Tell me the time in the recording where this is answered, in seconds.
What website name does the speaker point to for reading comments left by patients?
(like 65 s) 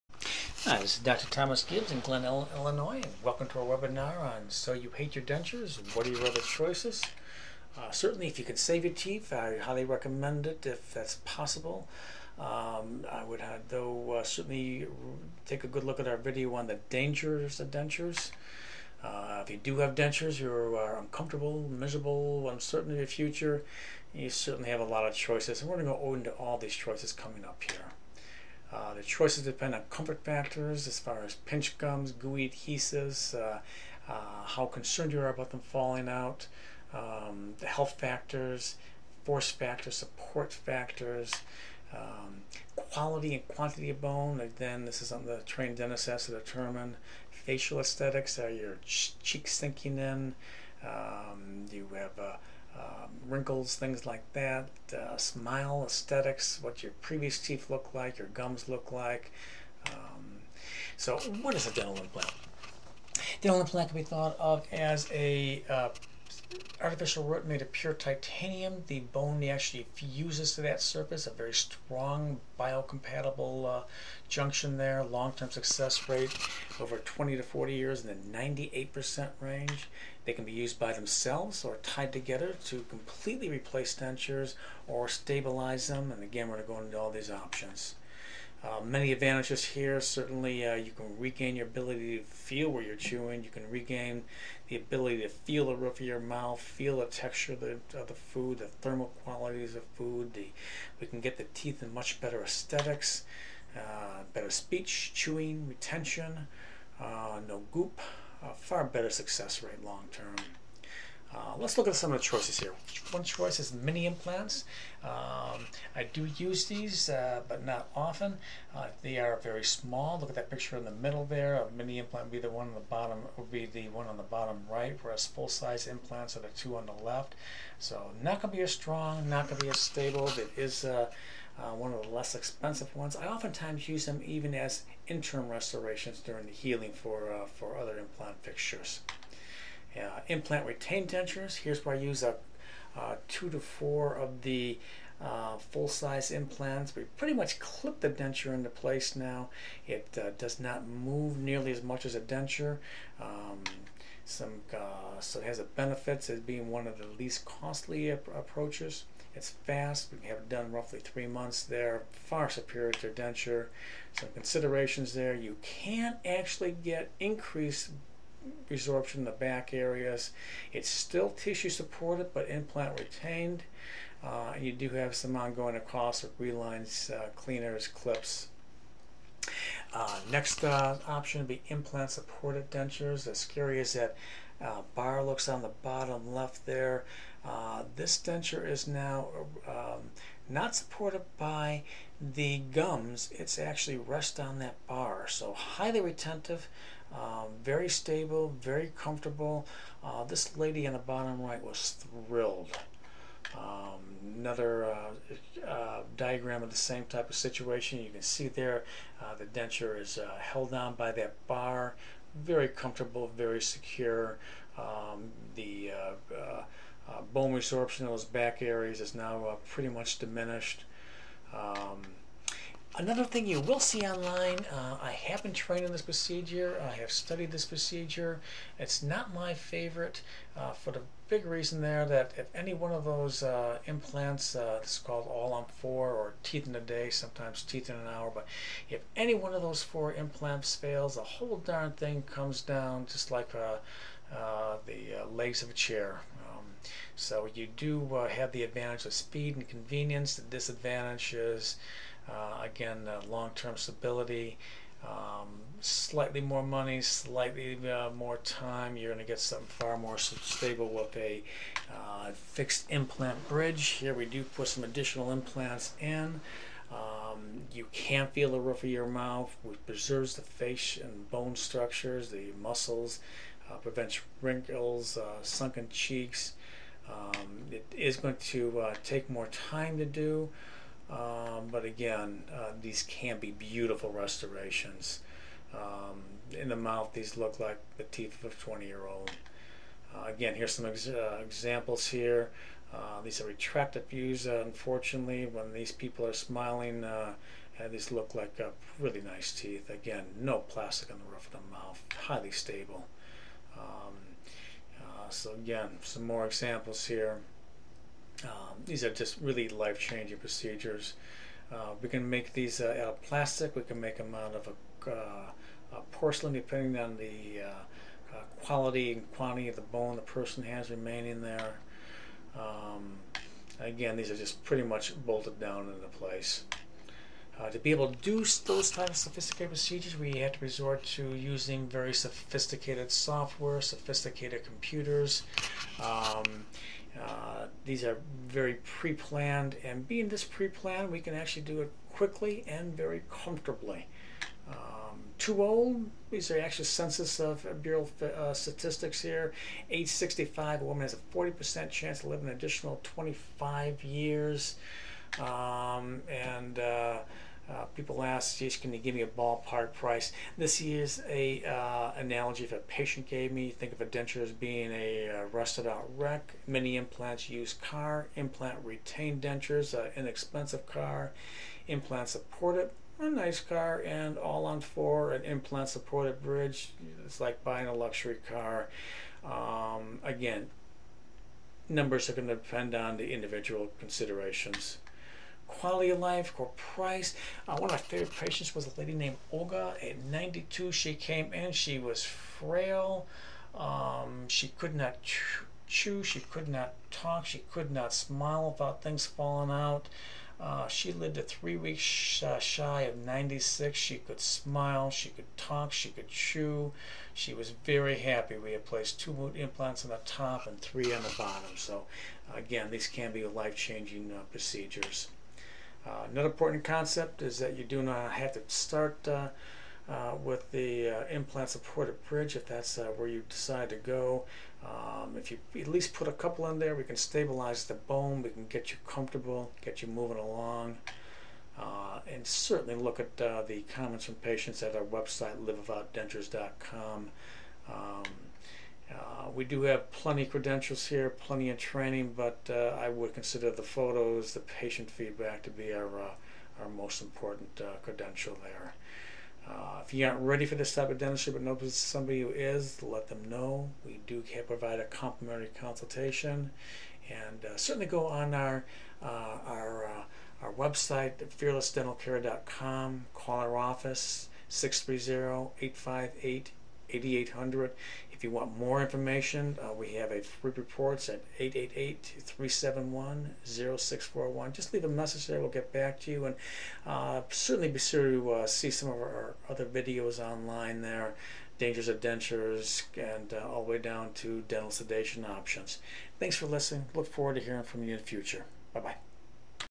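435 s.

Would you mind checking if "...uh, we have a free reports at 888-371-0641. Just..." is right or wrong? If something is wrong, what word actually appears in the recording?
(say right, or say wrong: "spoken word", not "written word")
right.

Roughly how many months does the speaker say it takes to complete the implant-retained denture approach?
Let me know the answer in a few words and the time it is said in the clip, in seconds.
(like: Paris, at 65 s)
3 months, at 160 s.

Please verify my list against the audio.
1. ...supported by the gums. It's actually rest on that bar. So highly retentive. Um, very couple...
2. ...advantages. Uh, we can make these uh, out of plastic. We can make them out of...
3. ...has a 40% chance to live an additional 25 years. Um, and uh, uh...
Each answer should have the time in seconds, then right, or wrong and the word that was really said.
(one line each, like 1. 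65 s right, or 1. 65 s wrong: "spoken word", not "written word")
1. 190 s wrong: "stable", not "couple"
2. 310 s wrong: "procedures", not "advantages"
3. 351 s right.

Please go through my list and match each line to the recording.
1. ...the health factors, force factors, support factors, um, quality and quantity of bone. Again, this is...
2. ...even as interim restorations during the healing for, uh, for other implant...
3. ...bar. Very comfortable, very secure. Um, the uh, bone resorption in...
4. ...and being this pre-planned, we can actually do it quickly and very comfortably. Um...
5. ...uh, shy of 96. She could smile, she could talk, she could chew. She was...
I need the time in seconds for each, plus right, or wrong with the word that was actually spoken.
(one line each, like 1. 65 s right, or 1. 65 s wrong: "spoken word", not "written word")
1. 37 s right
2. 134 s right
3. 211 s right
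4. 339 s right
5. 402 s right.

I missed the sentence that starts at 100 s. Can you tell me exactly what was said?
The, we can get the teeth in much better aesthetics, uh, better speech, chewing, retention, uh, no goop.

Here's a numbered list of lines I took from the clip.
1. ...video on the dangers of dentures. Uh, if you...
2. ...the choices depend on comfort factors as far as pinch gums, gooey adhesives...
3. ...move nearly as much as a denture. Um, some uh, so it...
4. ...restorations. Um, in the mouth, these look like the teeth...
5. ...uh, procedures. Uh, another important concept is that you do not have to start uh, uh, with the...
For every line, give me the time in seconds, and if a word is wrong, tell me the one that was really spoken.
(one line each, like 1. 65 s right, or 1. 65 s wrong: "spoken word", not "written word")
1. 16 s right
2. 28 s right
3. 150 s right
4. 284 s right
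5. 414 s right.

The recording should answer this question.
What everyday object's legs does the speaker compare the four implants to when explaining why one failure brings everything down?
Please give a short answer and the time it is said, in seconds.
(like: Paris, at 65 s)
a chair, at 245 s.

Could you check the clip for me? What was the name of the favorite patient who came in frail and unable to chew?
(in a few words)
Olga.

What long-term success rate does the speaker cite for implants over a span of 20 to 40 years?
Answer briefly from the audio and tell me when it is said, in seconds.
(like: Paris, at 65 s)
98%, at 78 s.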